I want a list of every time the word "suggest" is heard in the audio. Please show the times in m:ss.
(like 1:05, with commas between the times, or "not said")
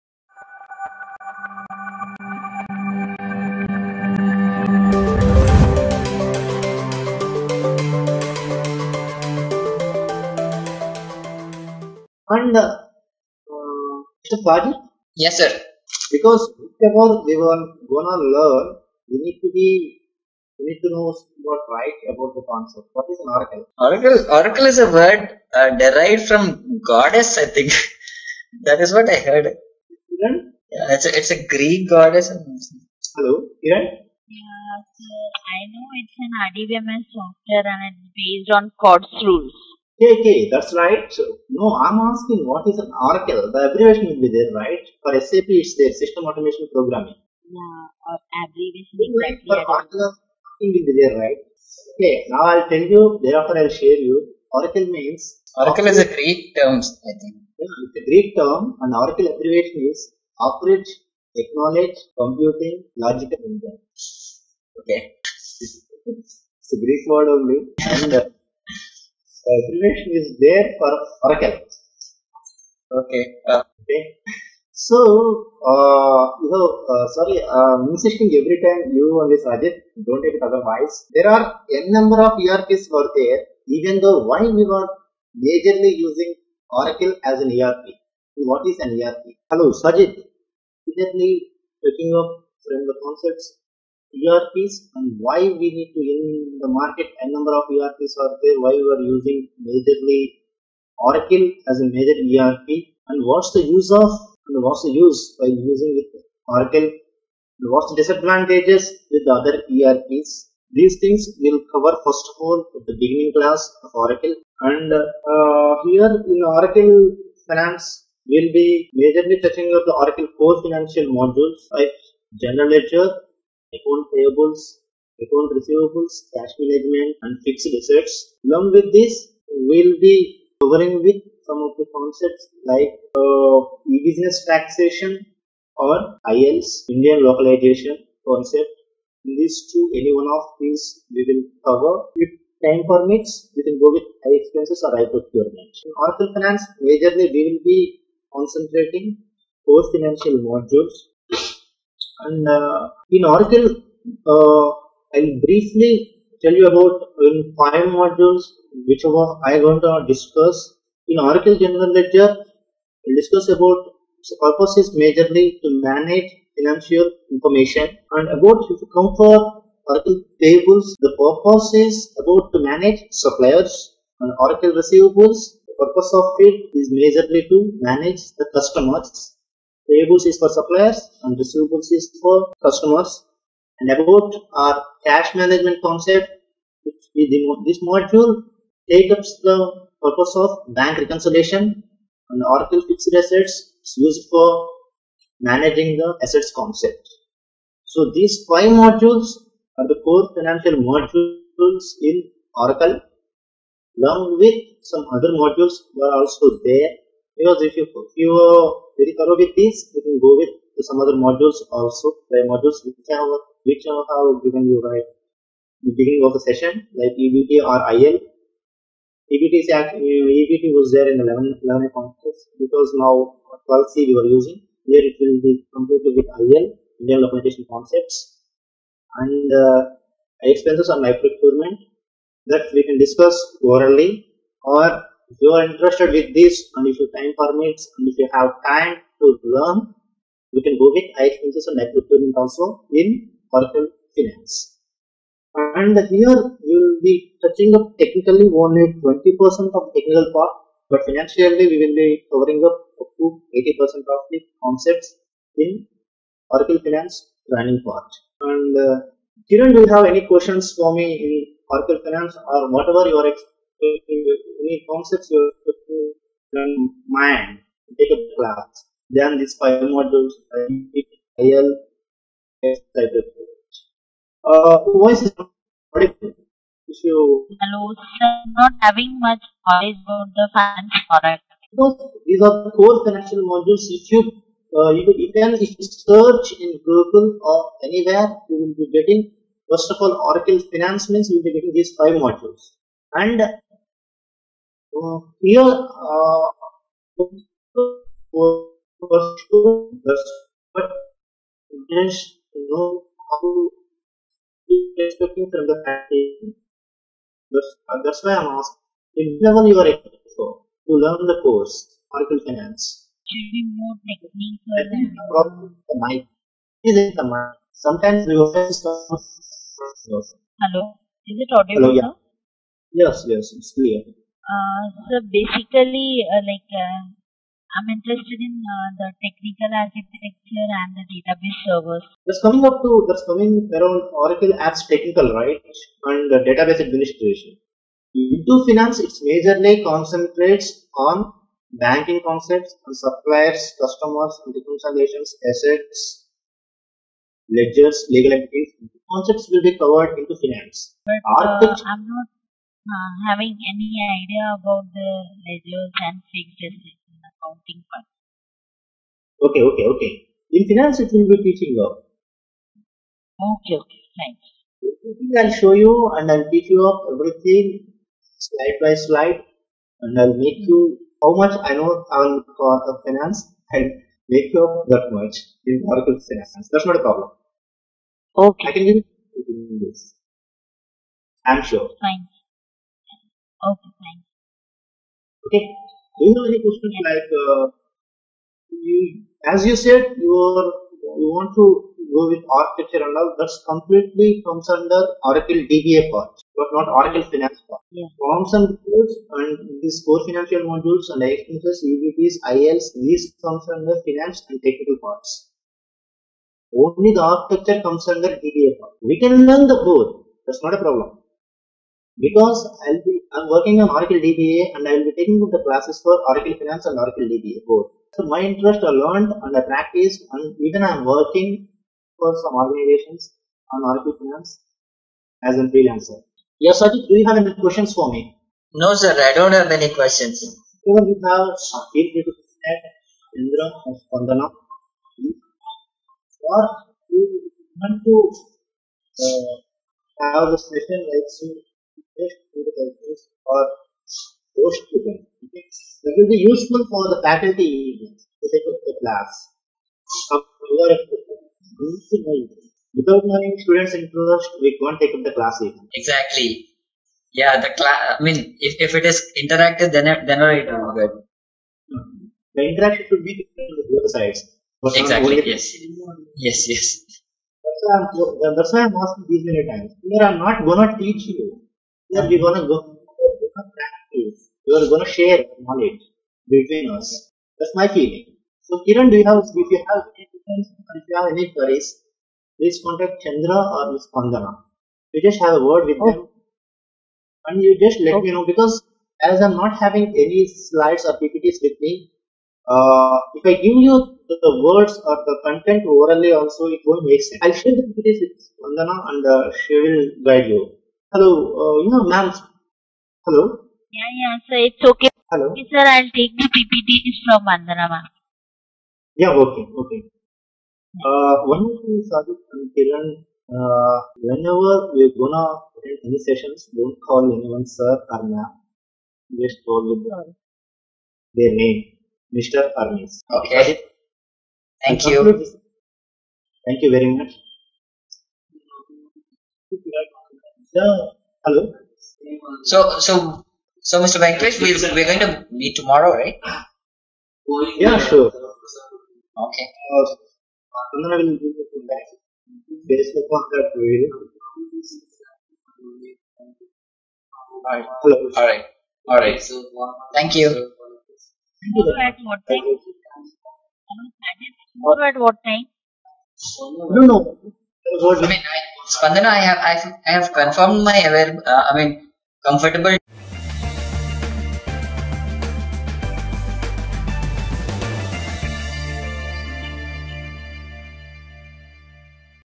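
1:19.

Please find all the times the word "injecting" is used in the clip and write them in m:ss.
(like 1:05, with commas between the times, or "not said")
not said.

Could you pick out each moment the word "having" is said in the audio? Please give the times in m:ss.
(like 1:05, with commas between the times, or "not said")
4:38, 5:53, 8:09.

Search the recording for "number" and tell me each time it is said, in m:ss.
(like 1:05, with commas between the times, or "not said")
1:21, 1:37.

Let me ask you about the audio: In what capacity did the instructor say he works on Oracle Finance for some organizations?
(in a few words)
Freelancer.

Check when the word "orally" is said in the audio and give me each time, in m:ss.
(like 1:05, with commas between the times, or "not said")
3:53, 8:15.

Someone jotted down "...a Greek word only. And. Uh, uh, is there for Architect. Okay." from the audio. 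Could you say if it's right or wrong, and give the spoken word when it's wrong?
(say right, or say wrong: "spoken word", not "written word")
wrong: "Oracle", not "Architect".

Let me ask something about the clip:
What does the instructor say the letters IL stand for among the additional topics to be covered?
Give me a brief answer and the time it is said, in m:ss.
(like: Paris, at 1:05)
Indian localization, at 2:16.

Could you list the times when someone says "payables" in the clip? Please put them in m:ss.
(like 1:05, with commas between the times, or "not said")
2:04, 2:50, 2:59.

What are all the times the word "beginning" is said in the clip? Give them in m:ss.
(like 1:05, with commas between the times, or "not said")
1:53, 3:35.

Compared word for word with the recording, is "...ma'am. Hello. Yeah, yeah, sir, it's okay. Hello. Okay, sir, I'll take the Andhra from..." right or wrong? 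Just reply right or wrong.
wrong.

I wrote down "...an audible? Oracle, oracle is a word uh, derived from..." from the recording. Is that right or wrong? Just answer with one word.
wrong.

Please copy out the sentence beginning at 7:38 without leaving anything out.
I mean, if, if it is interactive, then then it will be good.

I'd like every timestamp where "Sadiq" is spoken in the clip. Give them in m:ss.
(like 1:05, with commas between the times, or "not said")
8:32, 8:43.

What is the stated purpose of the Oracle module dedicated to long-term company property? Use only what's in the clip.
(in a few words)
Managing the assets.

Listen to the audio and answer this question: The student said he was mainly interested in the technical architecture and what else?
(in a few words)
Database servers.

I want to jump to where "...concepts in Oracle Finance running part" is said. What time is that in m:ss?
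4:14.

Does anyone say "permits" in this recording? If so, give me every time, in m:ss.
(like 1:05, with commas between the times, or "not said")
2:22, 3:57.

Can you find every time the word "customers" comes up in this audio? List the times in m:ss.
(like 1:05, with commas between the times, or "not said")
2:58, 3:02, 5:43.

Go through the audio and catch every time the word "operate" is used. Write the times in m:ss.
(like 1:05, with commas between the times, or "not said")
0:55, 1:00.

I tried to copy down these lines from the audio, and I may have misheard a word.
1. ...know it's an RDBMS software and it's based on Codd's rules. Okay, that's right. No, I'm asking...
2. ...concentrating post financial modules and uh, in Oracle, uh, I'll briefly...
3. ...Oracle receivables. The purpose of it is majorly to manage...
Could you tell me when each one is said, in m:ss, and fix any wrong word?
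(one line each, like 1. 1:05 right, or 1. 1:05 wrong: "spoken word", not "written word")
1. 0:35 right
2. 2:28 right
3. 2:54 right.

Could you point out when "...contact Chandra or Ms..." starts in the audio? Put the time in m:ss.
8:02.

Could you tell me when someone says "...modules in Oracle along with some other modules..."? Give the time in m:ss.
3:20.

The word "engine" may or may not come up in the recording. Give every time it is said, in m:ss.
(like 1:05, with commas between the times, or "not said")
1:03.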